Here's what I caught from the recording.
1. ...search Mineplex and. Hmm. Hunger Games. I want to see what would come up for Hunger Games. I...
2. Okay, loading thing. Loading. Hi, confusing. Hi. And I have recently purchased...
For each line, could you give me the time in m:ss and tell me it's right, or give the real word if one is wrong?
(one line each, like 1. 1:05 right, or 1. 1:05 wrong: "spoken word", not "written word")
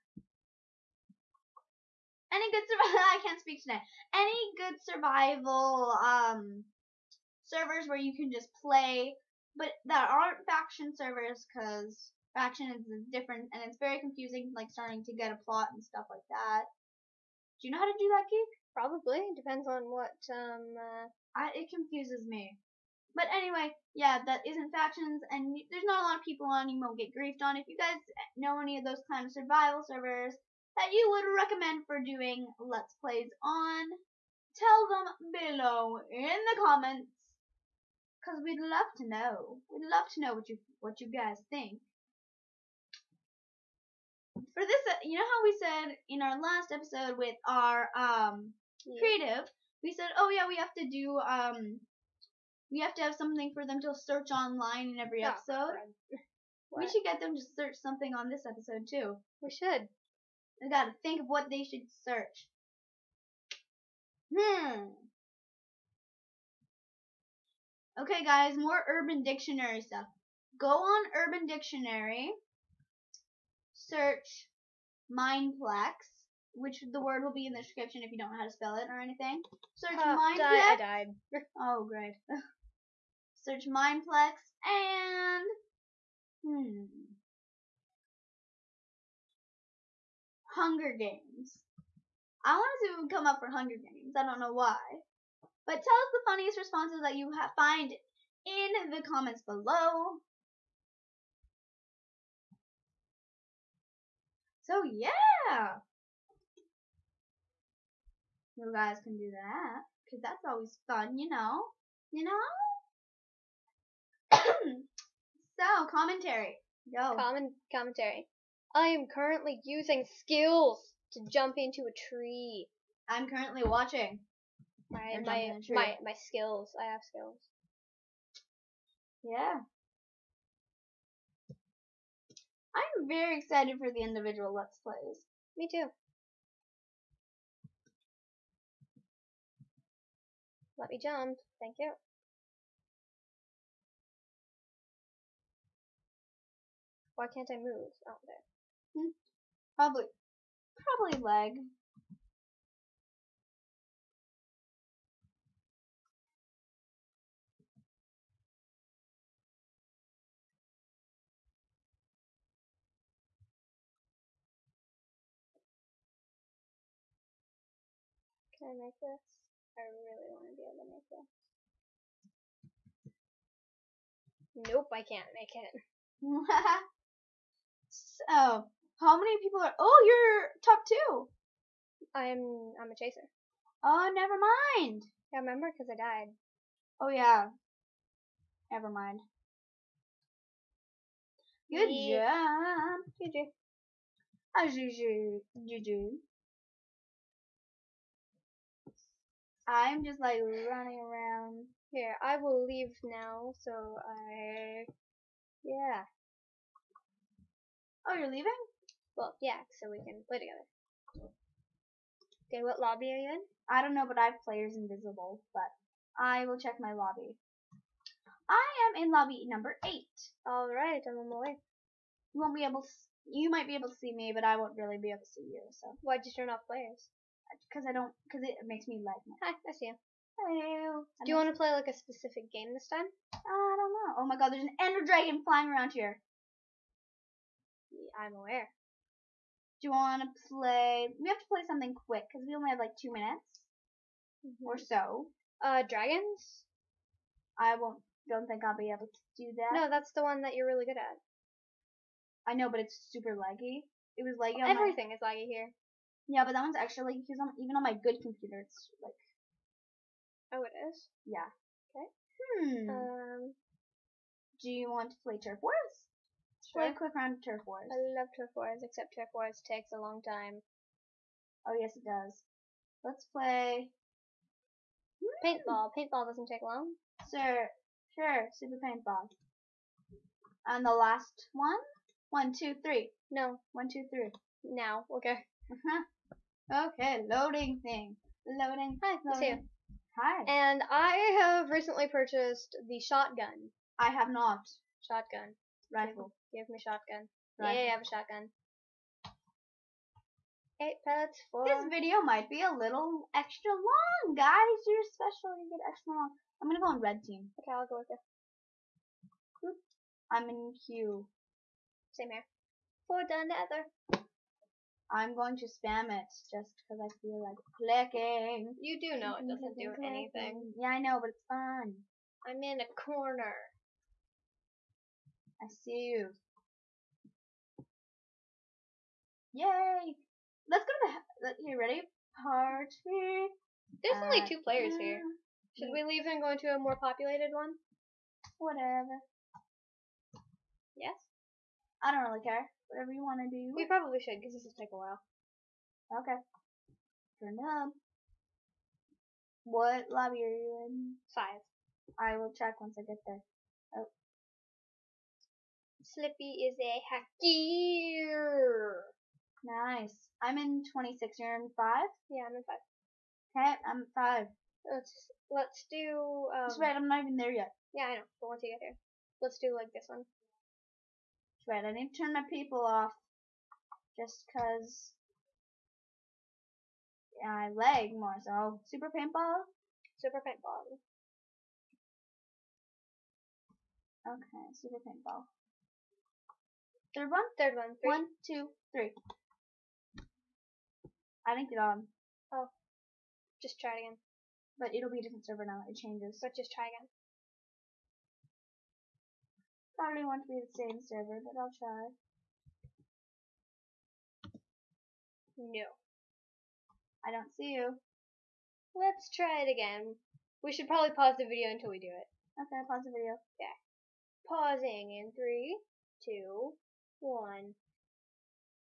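1. 1:23 right
2. 4:46 wrong: "loading", not "confusing".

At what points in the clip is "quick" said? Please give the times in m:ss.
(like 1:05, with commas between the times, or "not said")
4:02, 4:26.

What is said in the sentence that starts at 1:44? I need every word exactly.
So yeah, you guys can do that because that's always fun, you know, you know.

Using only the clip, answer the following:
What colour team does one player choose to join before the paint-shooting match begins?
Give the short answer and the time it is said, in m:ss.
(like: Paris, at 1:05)
Red, at 5:06.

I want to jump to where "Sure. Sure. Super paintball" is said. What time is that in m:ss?
4:37.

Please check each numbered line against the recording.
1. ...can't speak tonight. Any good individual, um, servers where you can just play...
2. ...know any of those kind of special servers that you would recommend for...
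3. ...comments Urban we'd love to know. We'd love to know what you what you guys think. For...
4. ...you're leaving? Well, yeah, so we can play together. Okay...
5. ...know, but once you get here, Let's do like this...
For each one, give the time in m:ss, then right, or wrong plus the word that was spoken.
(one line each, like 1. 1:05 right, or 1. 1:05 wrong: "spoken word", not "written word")
1. 0:03 wrong: "survival", not "individual"
2. 0:28 wrong: "survival", not "special"
3. 0:36 wrong: "Cause", not "Urban"
4. 3:28 right
5. 6:08 right.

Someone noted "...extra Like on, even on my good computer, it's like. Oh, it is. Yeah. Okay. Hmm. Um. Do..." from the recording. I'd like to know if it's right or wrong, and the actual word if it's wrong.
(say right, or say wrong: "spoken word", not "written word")
right.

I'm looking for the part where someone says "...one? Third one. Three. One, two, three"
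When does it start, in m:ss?
6:27.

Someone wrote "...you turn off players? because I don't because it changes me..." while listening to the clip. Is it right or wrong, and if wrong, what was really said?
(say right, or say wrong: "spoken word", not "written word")
wrong: "makes", not "changes".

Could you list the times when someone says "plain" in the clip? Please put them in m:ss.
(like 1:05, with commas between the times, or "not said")
not said.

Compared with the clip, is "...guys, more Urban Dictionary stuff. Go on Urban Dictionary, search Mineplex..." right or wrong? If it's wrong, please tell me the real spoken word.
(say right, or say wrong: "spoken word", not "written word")
right.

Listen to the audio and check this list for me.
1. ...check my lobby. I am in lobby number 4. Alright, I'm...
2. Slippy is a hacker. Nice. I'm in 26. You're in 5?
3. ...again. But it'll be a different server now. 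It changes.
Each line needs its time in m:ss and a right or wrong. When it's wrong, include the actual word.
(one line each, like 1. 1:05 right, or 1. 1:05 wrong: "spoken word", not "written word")
1. 3:36 wrong: "8", not "4"
2. 5:56 right
3. 6:34 right.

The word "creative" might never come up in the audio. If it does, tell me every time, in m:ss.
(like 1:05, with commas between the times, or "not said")
0:48.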